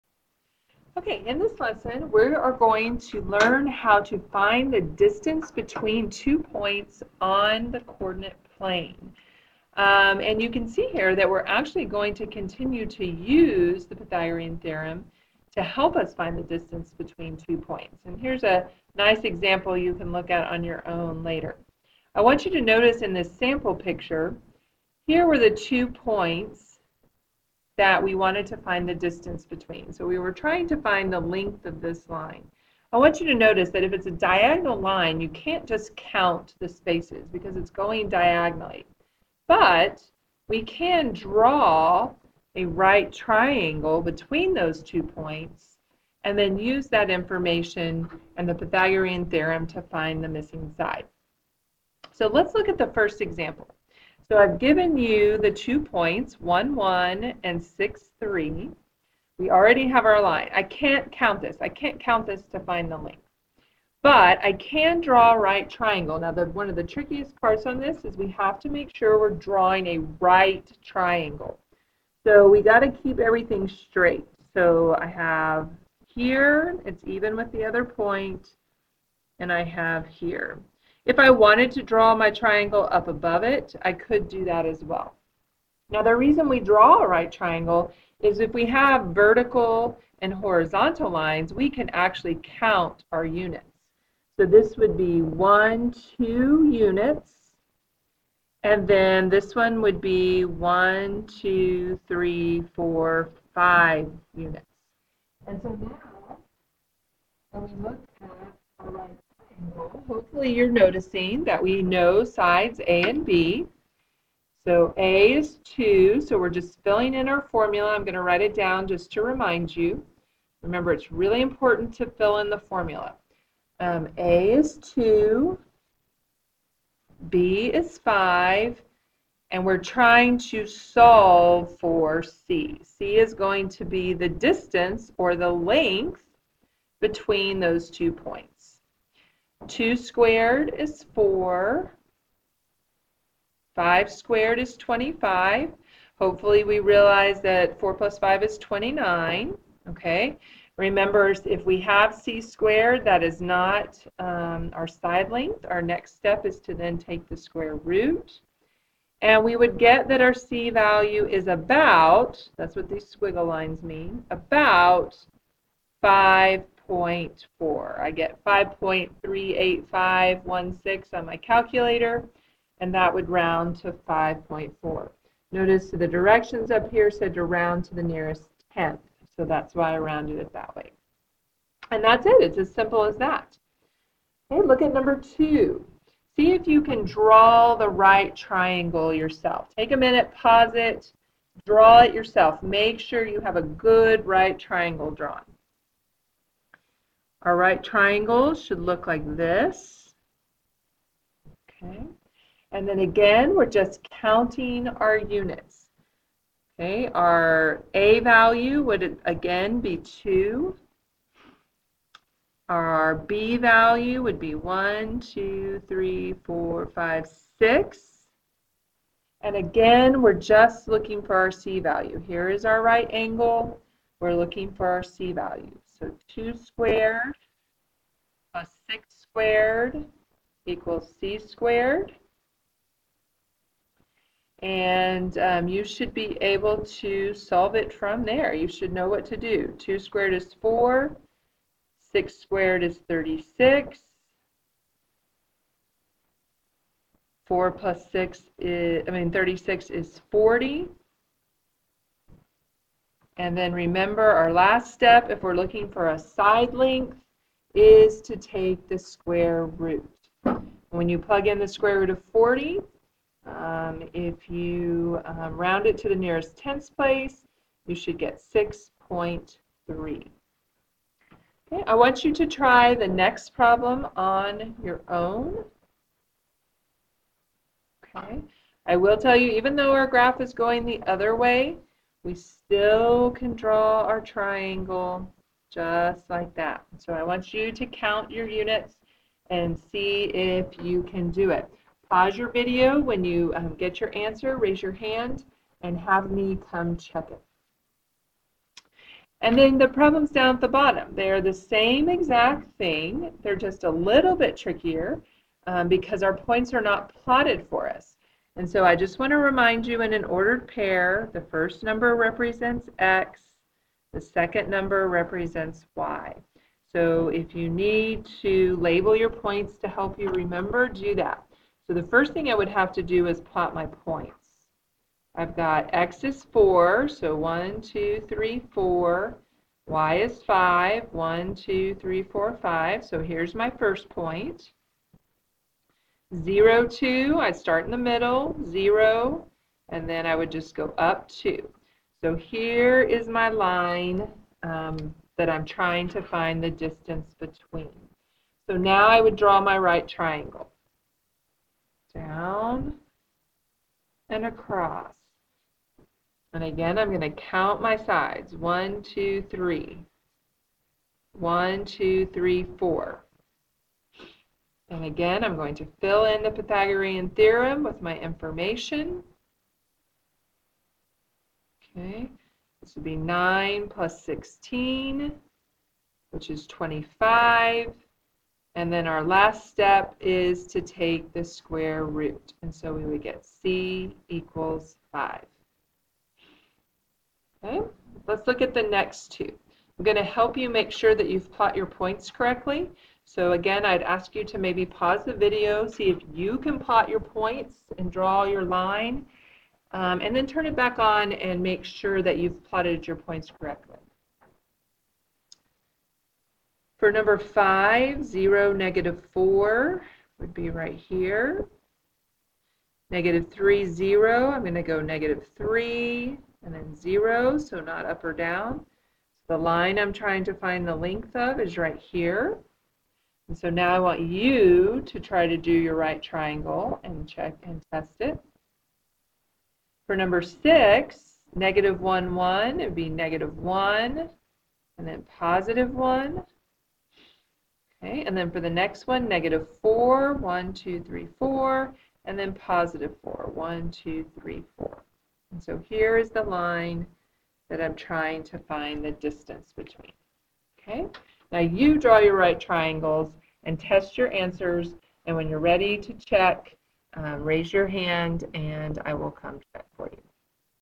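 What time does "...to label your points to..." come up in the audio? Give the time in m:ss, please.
5:18.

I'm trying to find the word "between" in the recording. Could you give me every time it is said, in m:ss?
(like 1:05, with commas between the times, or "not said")
0:05, 0:16, 0:29, 0:44, 2:16, 5:47, 7:29.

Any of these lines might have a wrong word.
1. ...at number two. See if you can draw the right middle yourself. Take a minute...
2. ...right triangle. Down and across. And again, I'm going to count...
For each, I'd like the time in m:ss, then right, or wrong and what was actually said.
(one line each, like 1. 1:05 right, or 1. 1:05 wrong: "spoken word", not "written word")
1. 3:04 wrong: "triangle", not "middle"
2. 5:49 right.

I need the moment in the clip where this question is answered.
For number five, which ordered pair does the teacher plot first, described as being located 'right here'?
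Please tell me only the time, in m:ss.
6:48.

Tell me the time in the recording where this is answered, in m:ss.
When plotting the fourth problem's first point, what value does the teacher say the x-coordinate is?
5:25.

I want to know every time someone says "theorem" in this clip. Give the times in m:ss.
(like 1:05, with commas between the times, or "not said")
0:14, 0:49, 6:07.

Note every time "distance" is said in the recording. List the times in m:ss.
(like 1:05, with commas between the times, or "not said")
0:04, 0:16, 0:28, 2:14, 5:46, 7:29.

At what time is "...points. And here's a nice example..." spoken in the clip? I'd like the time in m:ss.
0:17.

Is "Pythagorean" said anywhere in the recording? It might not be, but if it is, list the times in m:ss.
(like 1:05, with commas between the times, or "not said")
0:13, 0:48, 6:06.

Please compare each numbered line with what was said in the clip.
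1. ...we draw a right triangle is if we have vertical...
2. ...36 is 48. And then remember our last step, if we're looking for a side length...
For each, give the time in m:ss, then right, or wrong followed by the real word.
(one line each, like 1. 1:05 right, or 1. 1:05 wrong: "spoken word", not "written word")
1. 1:26 right
2. 4:09 wrong: "40", not "48".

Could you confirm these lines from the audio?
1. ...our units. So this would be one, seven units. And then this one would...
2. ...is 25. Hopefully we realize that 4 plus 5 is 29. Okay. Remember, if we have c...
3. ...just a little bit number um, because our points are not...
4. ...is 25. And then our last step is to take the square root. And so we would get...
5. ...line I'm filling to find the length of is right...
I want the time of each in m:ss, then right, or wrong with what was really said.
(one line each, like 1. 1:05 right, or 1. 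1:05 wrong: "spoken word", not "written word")
1. 1:33 wrong: "two", not "seven"
2. 2:24 right
3. 5:03 wrong: "trickier", not "number"
4. 6:16 right
5. 6:59 wrong: "trying", not "filling".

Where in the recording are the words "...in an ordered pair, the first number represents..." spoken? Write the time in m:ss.
5:10.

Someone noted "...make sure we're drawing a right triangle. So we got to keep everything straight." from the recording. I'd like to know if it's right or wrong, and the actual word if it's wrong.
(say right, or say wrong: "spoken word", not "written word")
right.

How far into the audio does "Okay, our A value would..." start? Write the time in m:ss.
3:26.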